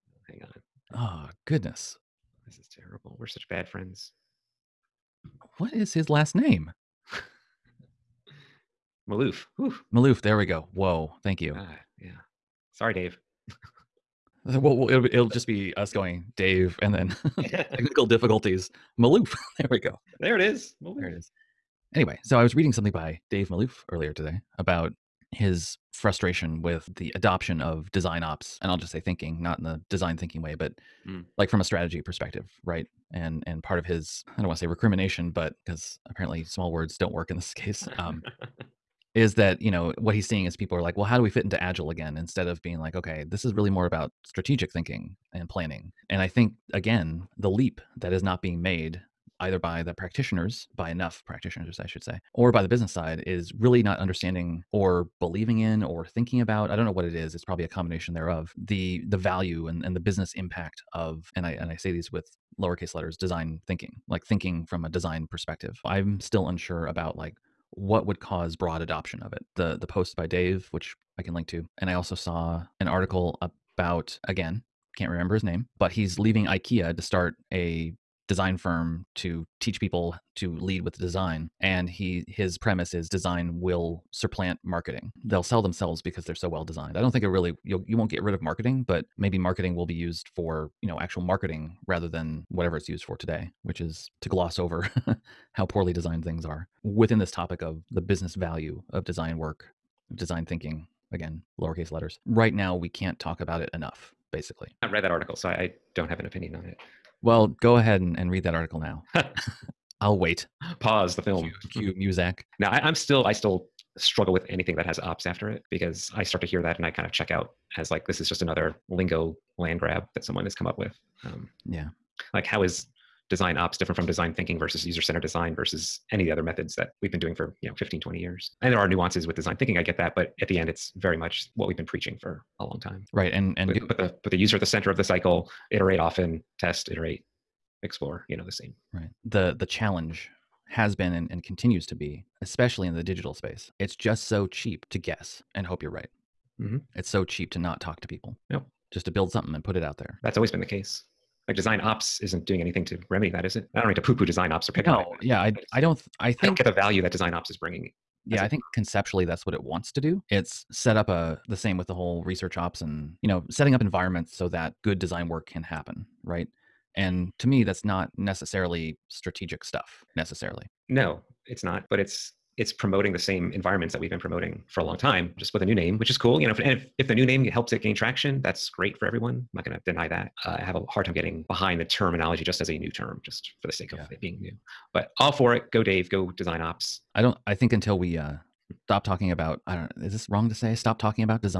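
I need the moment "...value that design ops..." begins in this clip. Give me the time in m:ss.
2:36.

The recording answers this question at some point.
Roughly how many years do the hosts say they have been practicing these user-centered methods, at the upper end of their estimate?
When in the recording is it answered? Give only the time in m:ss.
2:08.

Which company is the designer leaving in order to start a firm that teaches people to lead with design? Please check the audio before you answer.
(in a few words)
IKEA.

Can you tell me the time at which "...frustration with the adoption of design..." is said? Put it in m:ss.
0:25.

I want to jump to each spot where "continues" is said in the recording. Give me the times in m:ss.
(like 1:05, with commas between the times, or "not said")
2:21.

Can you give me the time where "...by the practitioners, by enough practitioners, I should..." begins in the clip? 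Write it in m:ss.
0:49.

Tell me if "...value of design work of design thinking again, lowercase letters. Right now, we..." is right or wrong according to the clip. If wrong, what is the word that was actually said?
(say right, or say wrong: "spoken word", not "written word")
right.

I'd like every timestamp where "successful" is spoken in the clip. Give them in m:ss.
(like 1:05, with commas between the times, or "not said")
not said.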